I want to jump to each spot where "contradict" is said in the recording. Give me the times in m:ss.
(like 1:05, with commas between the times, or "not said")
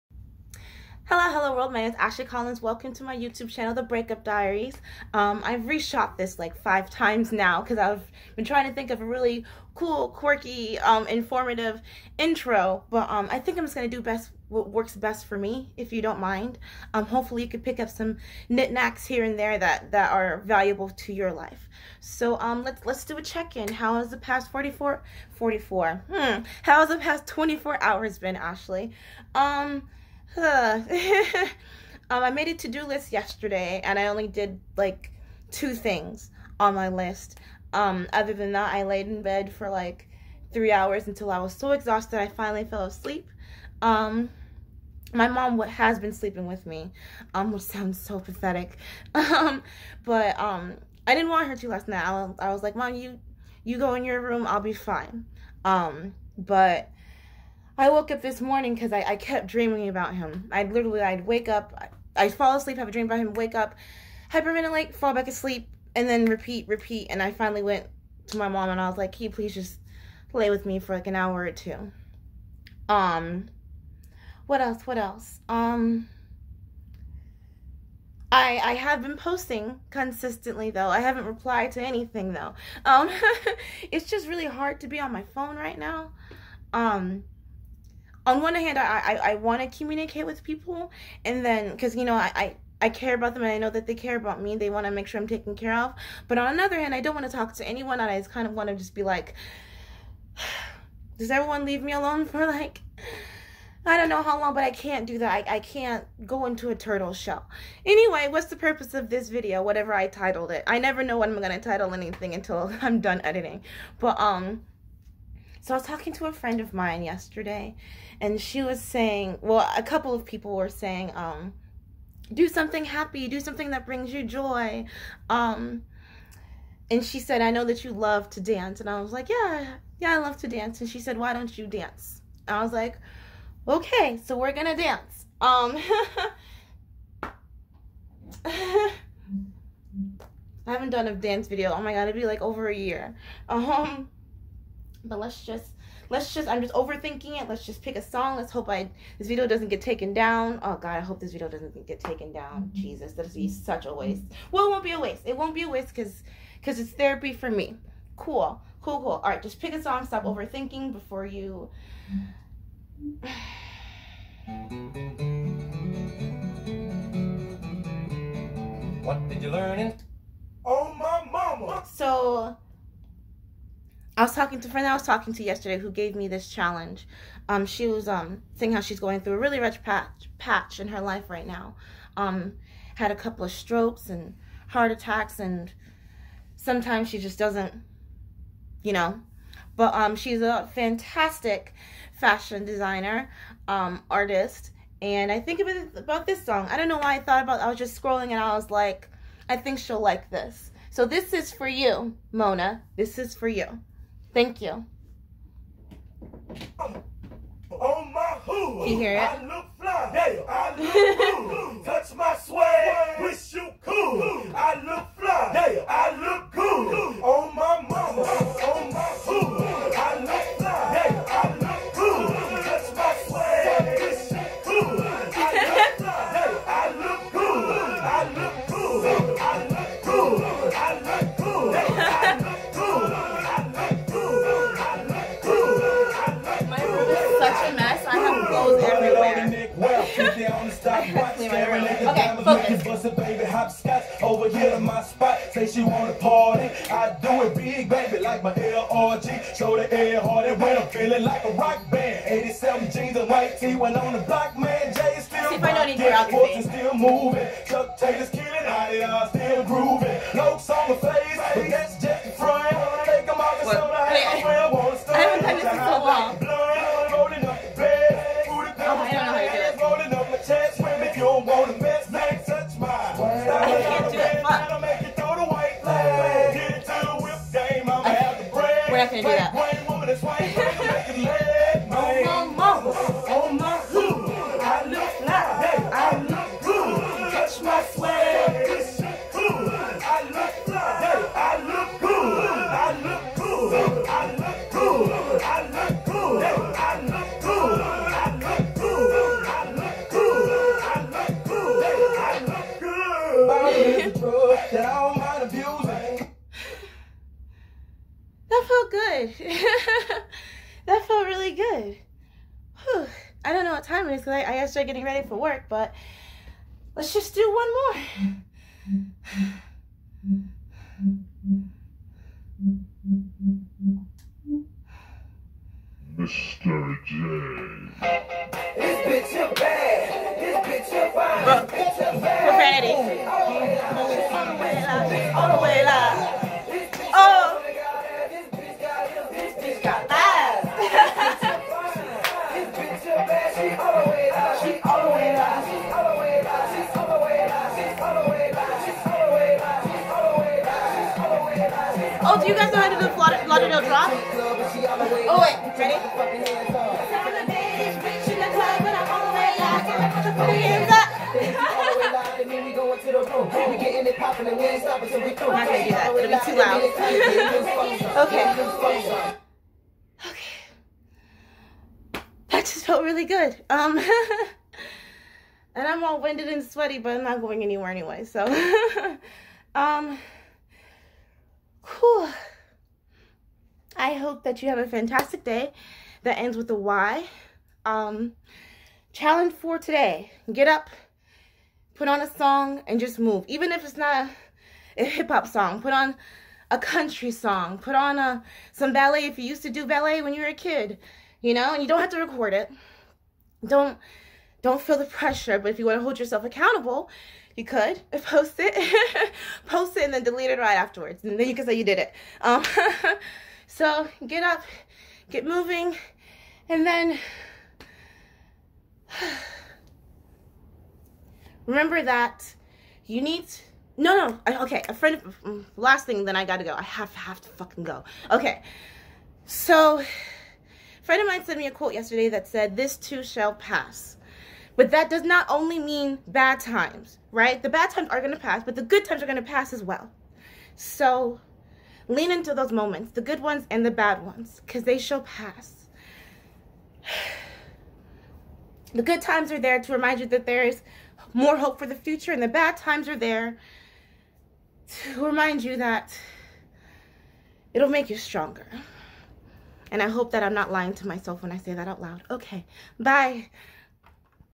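not said.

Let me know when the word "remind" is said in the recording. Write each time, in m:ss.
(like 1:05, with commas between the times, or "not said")
7:29, 7:35.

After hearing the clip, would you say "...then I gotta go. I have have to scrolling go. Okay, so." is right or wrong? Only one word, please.
wrong.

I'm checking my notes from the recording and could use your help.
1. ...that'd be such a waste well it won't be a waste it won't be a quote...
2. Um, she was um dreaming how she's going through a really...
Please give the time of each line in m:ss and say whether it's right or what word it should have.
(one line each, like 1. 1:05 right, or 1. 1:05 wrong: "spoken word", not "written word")
1. 2:33 wrong: "waste", not "quote"
2. 2:57 wrong: "saying", not "dreaming".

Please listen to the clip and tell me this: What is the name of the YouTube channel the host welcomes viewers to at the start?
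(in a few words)
The Breakup Diaries.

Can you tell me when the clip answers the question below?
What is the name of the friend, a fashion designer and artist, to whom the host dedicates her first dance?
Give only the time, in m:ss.
3:22.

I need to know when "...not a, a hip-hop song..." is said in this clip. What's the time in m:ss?
6:33.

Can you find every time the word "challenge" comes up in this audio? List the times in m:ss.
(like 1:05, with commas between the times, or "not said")
2:56, 6:29.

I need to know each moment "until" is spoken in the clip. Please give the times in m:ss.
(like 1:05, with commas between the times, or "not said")
0:41, 1:52.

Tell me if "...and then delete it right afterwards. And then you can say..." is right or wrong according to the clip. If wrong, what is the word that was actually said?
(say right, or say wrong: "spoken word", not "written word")
right.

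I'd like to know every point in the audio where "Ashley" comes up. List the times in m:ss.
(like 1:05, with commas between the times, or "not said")
0:01, 0:28.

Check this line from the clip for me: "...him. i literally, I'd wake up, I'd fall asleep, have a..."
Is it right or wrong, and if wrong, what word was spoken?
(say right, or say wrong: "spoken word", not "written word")
right.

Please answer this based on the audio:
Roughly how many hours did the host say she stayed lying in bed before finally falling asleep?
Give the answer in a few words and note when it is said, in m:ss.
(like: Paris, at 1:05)
3, at 0:40.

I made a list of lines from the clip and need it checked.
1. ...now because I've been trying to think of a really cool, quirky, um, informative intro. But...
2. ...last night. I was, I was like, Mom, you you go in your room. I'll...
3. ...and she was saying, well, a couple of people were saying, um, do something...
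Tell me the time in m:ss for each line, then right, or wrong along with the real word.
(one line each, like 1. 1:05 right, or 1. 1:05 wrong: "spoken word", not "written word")
1. 0:07 right
2. 0:51 right
3. 1:58 right.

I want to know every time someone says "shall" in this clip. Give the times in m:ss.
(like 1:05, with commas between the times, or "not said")
7:13, 7:24.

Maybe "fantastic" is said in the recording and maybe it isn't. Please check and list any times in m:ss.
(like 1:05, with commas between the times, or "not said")
3:10, 6:24.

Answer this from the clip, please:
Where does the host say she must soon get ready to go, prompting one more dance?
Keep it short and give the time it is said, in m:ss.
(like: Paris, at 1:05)
work, at 5:15.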